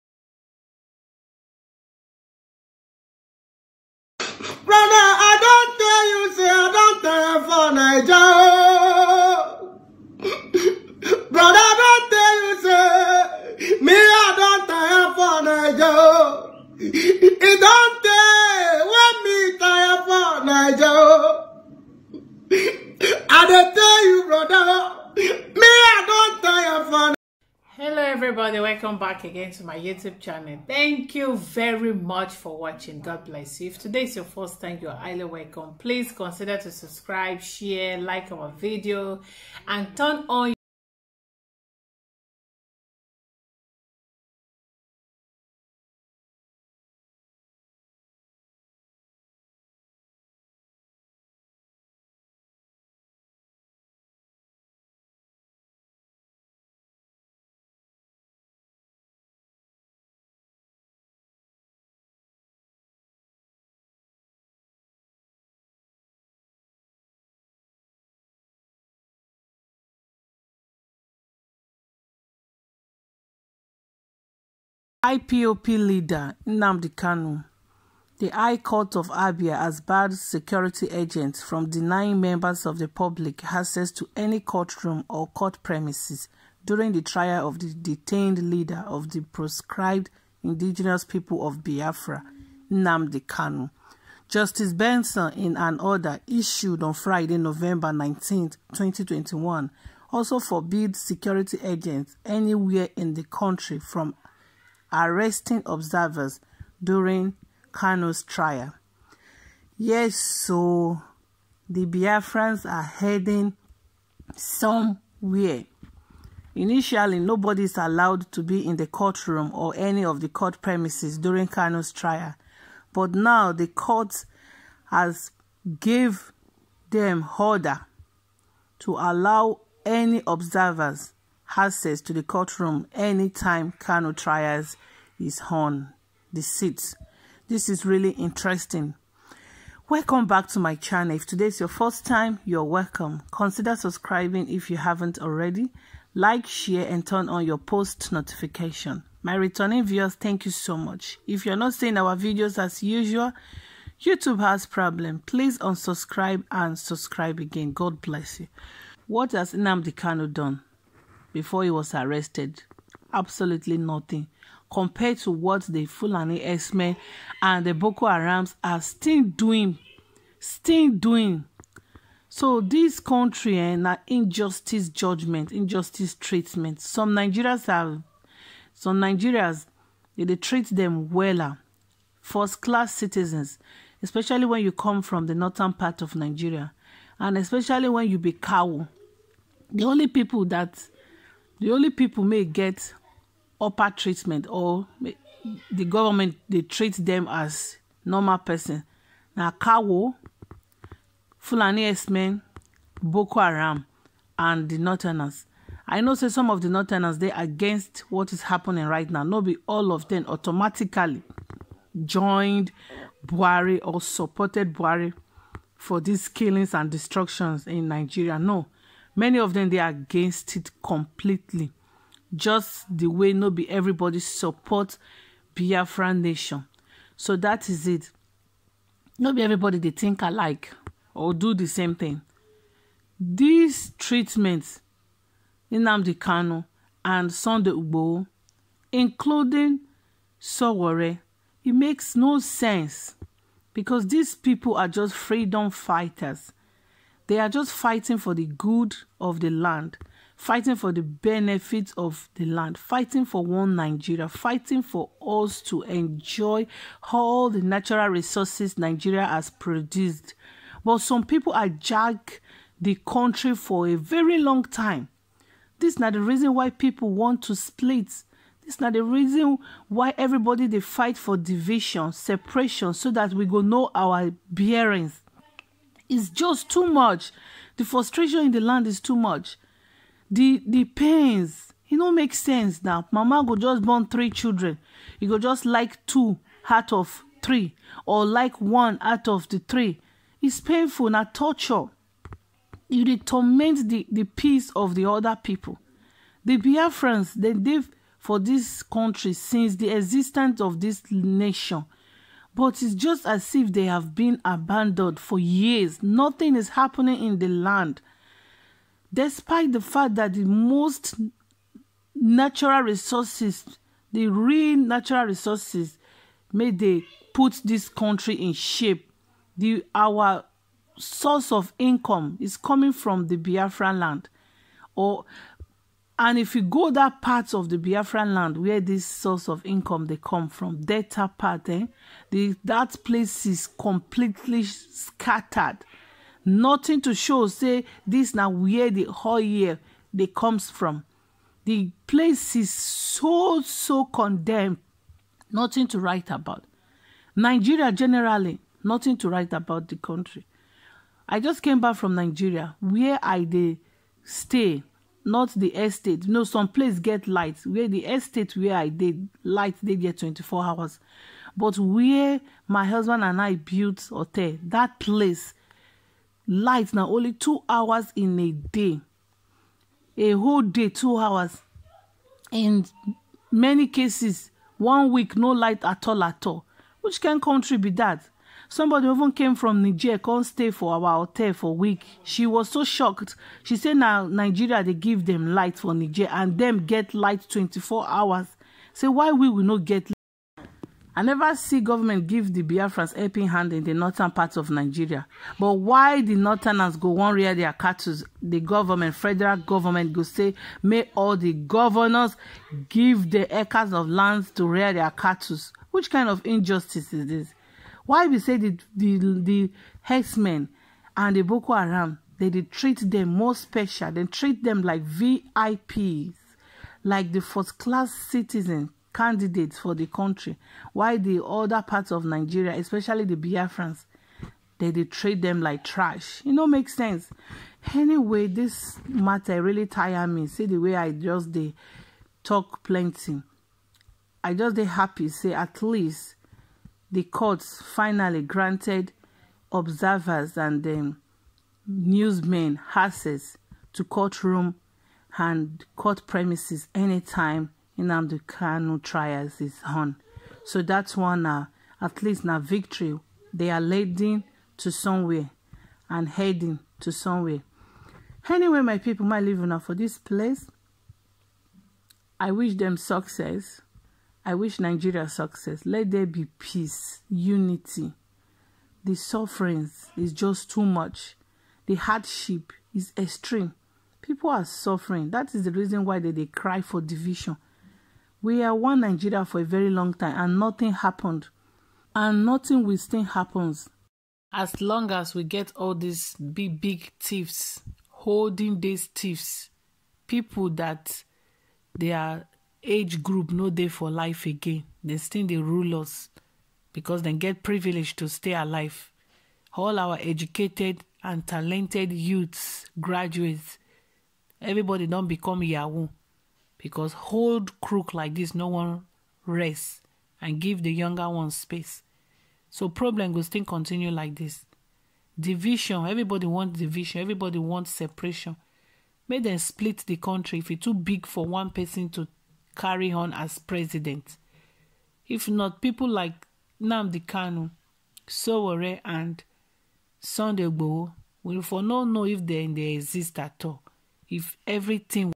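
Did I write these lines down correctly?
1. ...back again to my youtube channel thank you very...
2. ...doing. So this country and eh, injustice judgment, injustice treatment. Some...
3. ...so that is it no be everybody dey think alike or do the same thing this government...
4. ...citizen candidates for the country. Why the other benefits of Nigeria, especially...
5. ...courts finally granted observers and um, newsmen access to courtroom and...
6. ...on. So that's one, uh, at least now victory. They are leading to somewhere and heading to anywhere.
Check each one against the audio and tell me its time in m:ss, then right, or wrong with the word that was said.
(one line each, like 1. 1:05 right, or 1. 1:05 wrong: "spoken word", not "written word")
1. 0:29 right
2. 2:50 right
3. 3:47 wrong: "treatment", not "government"
4. 6:58 wrong: "parts", not "benefits"
5. 7:17 right
6. 7:29 wrong: "somewhere", not "anywhere".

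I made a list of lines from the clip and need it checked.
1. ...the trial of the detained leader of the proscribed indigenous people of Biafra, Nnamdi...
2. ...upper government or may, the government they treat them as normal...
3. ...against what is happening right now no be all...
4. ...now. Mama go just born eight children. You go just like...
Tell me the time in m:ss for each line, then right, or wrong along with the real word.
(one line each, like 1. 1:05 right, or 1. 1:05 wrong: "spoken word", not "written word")
1. 1:26 right
2. 3:13 wrong: "treatment", not "government"
3. 3:27 right
4. 4:42 wrong: "three", not "eight".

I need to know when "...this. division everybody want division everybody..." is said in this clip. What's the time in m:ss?
8:34.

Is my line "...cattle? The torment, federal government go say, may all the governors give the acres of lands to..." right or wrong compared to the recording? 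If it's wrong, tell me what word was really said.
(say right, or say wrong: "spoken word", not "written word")
wrong: "government", not "torment".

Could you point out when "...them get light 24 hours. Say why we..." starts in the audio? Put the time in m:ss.
6:26.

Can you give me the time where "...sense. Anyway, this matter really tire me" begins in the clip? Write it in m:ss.
7:06.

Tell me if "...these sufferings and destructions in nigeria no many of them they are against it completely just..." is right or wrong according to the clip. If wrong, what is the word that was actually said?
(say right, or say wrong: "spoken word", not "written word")
wrong: "killings", not "sufferings".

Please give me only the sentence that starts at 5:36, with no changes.
Nothing to show, say this now where the whole year they comes from.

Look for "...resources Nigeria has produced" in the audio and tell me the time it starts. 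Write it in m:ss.
4:18.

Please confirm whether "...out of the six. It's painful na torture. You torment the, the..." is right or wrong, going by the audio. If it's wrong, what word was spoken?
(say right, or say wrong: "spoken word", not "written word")
wrong: "three", not "six".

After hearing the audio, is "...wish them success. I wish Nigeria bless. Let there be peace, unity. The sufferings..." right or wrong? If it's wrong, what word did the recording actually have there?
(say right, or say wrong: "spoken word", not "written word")
wrong: "success", not "bless".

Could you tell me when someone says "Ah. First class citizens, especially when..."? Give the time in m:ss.
3:01.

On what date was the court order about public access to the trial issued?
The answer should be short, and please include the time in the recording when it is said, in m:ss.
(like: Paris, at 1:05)
November 19, 2021, at 1:37.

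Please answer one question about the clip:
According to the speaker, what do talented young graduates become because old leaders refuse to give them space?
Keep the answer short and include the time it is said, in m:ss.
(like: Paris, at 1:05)
yahoo, at 8:25.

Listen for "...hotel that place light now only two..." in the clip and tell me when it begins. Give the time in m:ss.
6:04.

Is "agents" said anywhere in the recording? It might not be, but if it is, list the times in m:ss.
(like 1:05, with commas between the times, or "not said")
1:20, 1:41.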